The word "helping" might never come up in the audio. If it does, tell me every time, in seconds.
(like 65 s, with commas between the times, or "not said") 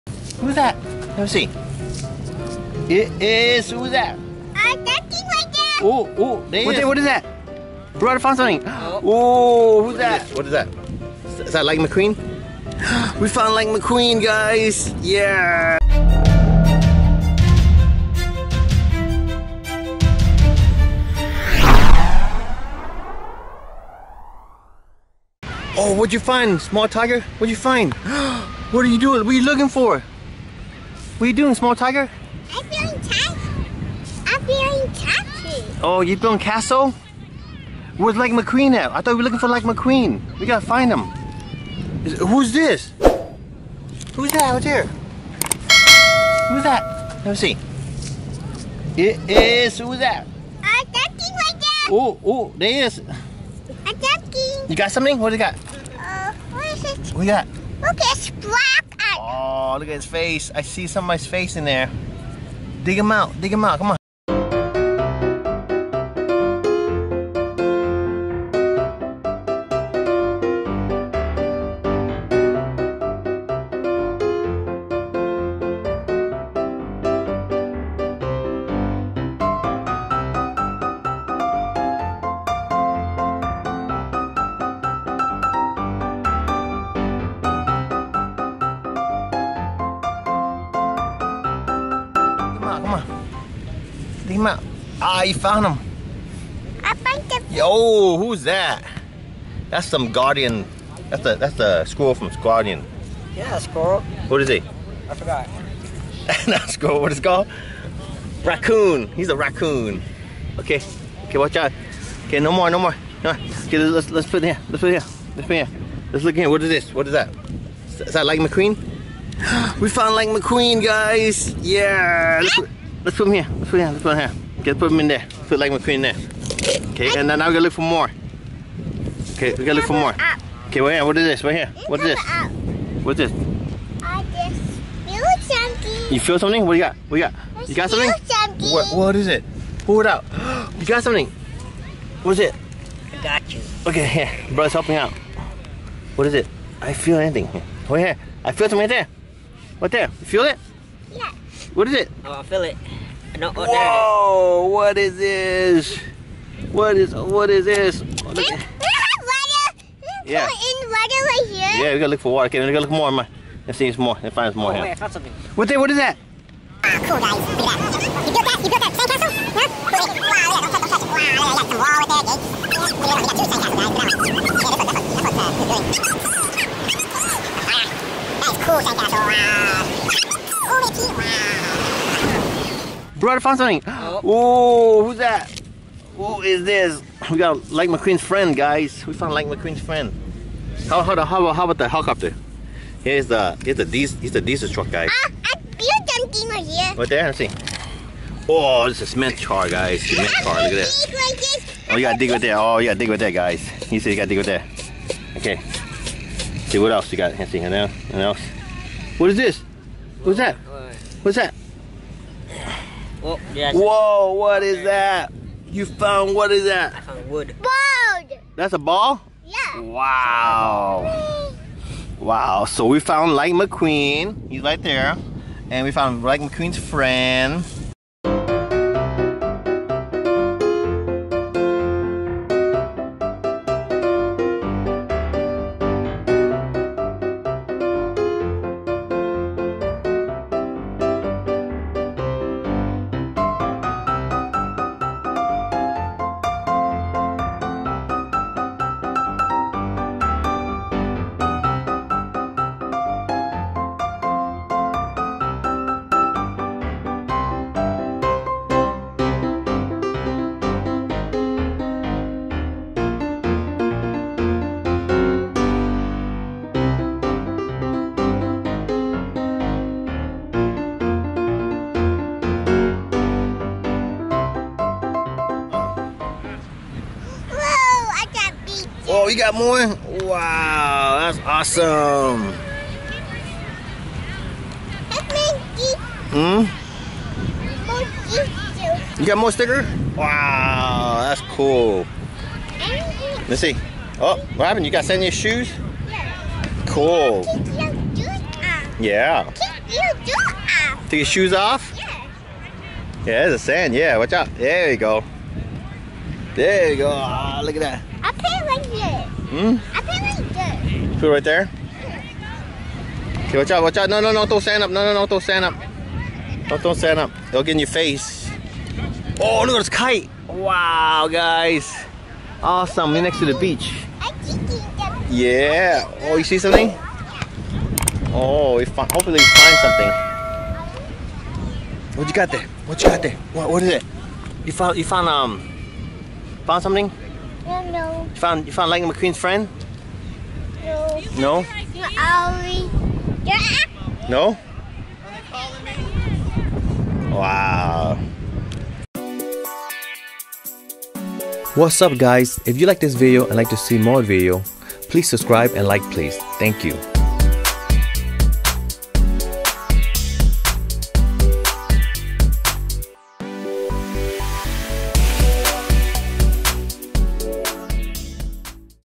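144 s.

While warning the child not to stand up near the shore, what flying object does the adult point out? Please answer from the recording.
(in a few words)
kite.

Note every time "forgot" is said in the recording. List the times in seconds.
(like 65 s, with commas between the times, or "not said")
105 s.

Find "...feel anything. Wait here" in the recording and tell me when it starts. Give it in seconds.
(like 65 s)
146 s.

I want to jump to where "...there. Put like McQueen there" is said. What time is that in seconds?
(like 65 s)
125 s.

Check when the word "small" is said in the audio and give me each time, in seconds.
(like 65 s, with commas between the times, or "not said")
26 s, 31 s.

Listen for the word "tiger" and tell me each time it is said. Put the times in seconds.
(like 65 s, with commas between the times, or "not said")
26 s, 31 s.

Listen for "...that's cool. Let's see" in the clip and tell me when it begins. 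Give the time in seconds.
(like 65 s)
291 s.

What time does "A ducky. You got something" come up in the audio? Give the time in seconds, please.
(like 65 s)
52 s.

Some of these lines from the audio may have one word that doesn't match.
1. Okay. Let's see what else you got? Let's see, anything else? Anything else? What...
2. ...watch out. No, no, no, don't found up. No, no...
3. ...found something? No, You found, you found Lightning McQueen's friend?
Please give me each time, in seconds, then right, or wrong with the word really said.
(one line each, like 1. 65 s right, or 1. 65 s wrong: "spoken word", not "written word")
1. 205 s right
2. 313 s wrong: "stand", not "found"
3. 336 s right.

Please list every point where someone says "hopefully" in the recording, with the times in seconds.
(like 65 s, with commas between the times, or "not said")
329 s.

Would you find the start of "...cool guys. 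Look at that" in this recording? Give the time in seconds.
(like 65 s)
167 s.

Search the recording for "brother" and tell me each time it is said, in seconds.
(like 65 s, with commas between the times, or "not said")
7 s, 144 s.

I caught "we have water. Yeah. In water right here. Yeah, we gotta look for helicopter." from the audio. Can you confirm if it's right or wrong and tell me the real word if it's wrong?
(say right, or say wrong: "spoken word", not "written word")
wrong: "water", not "helicopter".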